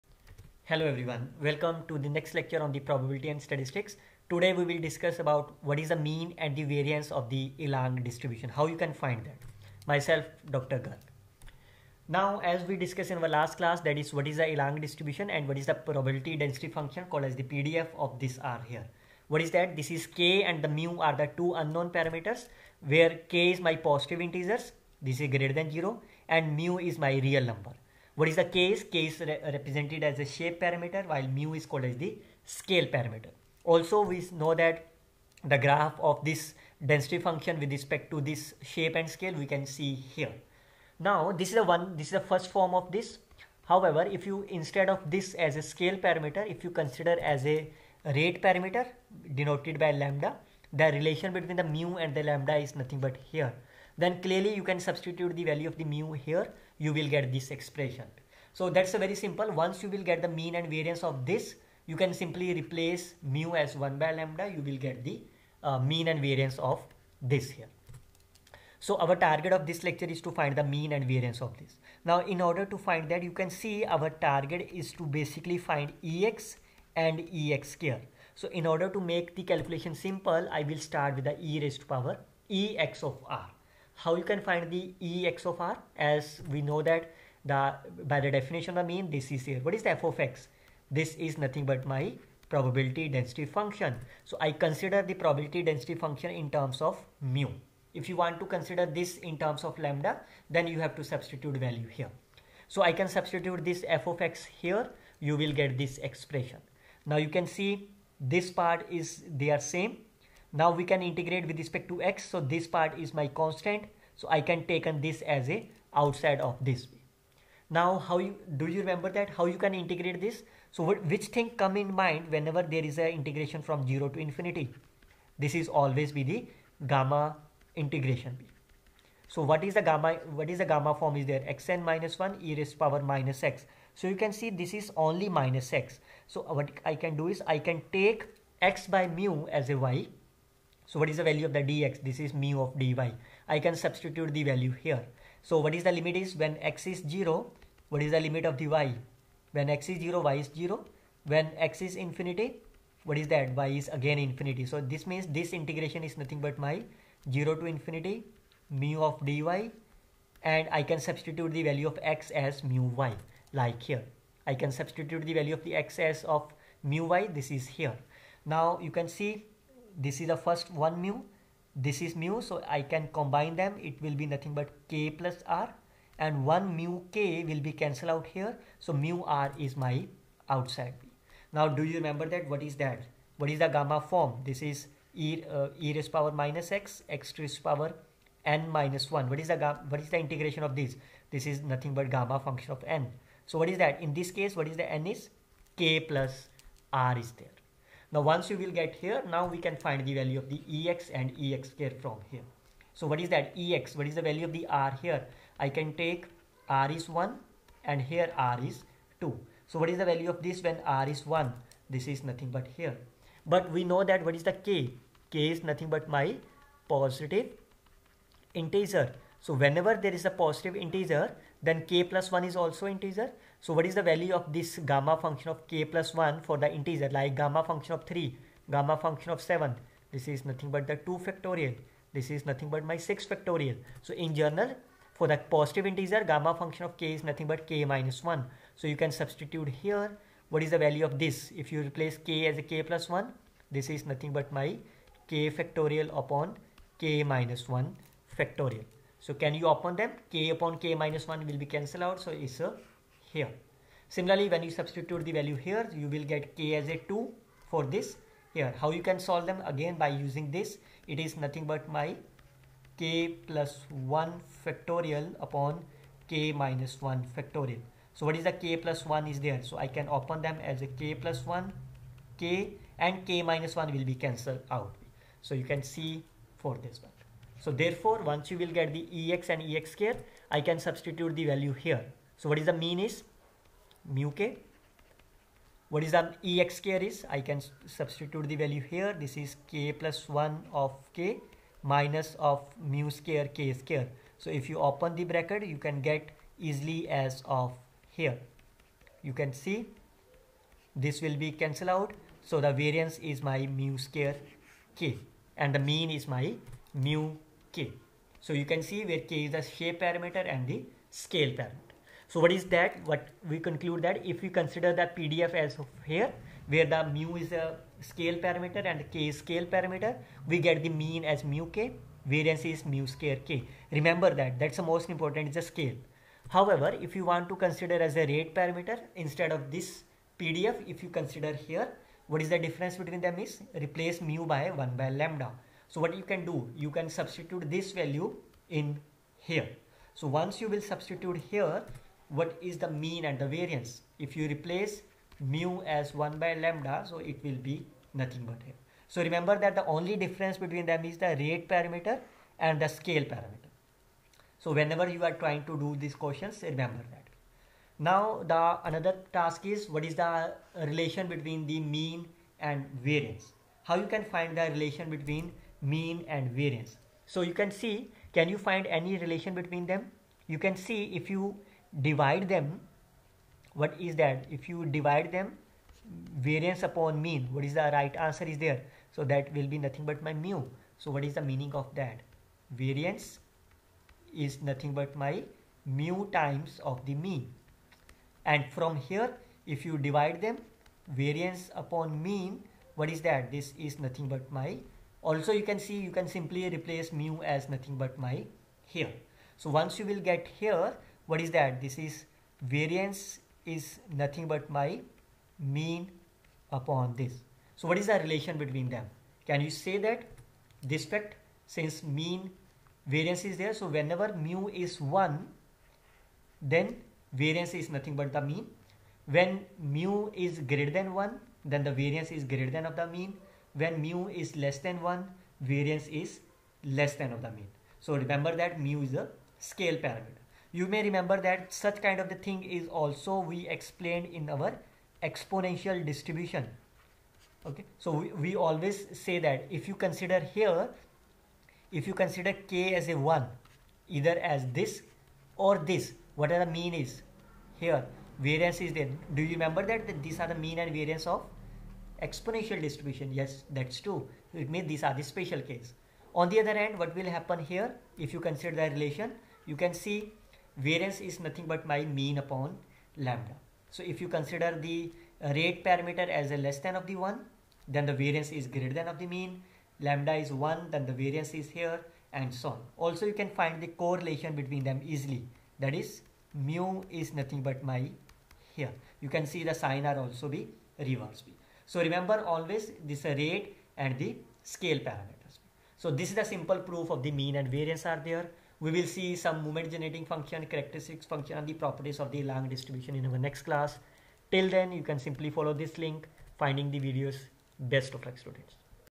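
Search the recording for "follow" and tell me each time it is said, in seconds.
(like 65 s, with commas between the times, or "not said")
495 s.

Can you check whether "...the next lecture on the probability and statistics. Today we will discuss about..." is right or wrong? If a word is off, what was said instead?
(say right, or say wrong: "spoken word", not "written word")
right.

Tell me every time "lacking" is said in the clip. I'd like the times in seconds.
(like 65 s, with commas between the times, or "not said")
not said.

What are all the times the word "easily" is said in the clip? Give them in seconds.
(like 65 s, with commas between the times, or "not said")
296 s, 475 s.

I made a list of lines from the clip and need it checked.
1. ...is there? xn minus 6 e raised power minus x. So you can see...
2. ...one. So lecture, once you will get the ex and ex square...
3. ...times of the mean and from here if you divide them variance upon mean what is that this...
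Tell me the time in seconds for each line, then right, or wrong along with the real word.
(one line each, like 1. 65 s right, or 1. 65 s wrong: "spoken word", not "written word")
1. 131 s wrong: "1", not "6"
2. 277 s wrong: "therefore", not "lecture"
3. 386 s right.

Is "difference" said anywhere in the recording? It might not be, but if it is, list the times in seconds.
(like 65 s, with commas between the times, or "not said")
332 s, 350 s.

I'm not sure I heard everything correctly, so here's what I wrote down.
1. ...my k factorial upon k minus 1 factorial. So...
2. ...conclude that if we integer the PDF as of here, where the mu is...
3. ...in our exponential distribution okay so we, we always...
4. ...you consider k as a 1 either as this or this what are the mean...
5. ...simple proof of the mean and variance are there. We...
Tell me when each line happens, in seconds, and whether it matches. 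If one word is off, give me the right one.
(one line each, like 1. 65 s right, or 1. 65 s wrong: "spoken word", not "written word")
1. 244 s right
2. 313 s wrong: "consider", not "integer"
3. 434 s right
4. 442 s right
5. 486 s right.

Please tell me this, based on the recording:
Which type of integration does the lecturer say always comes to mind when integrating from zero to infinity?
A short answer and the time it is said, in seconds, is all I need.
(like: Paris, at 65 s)
gamma integration, at 126 s.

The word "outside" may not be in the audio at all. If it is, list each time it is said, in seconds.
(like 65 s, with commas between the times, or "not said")
115 s, 180 s.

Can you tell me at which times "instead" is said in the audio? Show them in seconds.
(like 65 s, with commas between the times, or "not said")
44 s, 329 s.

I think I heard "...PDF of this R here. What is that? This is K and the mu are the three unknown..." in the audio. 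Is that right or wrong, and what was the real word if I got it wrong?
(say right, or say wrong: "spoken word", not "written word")
wrong: "two", not "three".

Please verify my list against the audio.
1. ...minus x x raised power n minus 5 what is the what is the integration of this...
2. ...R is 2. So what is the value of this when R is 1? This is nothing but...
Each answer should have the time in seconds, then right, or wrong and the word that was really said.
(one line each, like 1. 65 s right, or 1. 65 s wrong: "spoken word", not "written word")
1. 186 s wrong: "1", not "5"
2. 208 s right.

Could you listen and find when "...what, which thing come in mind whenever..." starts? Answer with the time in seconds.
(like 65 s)
120 s.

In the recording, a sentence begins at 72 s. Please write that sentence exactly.
Now in order to find that you can see our target is to basically find EX and EX square.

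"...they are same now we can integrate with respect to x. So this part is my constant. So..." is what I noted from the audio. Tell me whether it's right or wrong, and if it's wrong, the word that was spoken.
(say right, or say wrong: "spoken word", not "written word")
right.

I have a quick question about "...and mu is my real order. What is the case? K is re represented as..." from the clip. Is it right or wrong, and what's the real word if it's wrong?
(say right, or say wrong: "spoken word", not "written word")
wrong: "number", not "order".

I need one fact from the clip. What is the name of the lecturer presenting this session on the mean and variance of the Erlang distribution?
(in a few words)
Dr. Garg.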